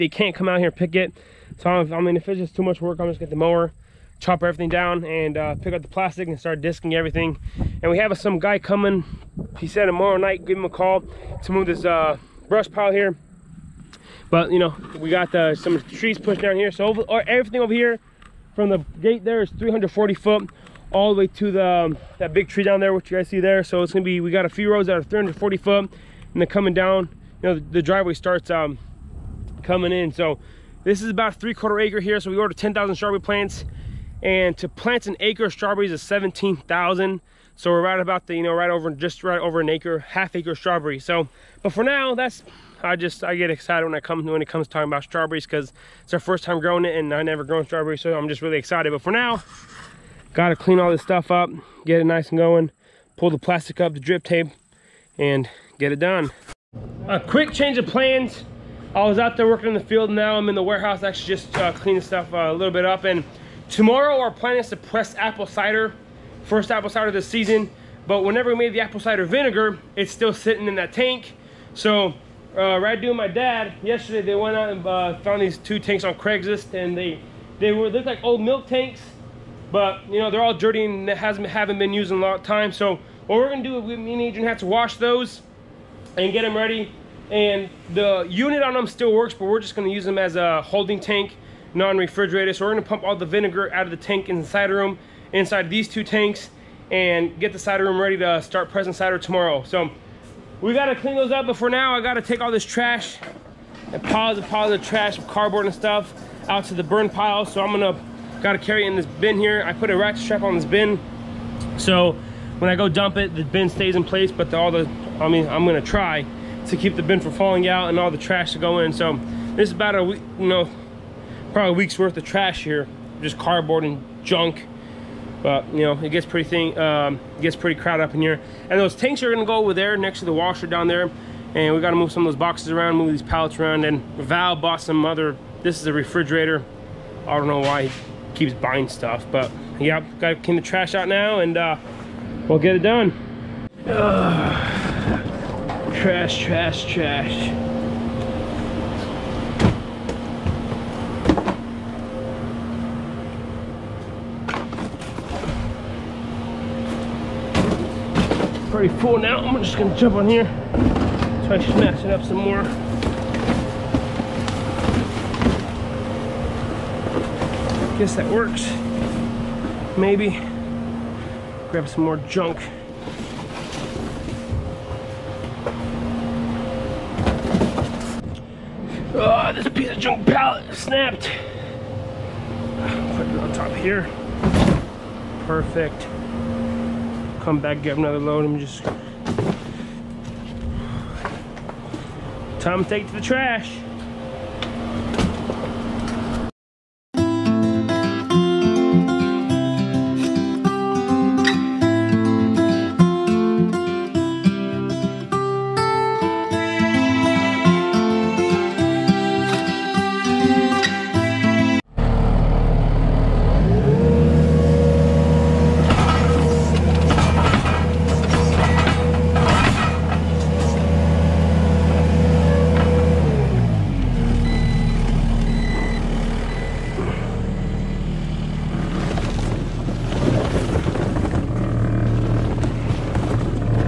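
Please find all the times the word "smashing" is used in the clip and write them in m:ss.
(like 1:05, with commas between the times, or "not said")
2:41.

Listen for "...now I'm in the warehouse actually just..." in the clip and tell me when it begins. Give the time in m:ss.
1:00.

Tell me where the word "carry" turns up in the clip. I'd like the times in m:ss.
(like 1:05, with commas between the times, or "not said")
1:48.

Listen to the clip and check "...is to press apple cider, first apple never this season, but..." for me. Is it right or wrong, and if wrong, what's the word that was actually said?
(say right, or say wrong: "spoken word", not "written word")
wrong: "cider", not "never".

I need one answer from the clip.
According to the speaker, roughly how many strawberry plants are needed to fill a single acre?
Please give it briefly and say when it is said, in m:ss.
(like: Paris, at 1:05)
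17,000, at 0:36.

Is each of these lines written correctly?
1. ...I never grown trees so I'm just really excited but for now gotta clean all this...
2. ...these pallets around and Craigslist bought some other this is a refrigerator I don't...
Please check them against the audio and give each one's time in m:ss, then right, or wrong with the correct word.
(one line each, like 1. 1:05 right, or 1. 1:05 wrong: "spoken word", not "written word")
1. 0:47 wrong: "strawberries", not "trees"
2. 2:13 wrong: "Val", not "Craigslist".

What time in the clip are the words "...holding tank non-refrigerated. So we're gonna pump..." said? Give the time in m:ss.
1:30.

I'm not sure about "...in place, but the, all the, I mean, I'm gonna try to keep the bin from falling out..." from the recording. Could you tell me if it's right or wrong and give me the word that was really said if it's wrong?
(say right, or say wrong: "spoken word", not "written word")
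right.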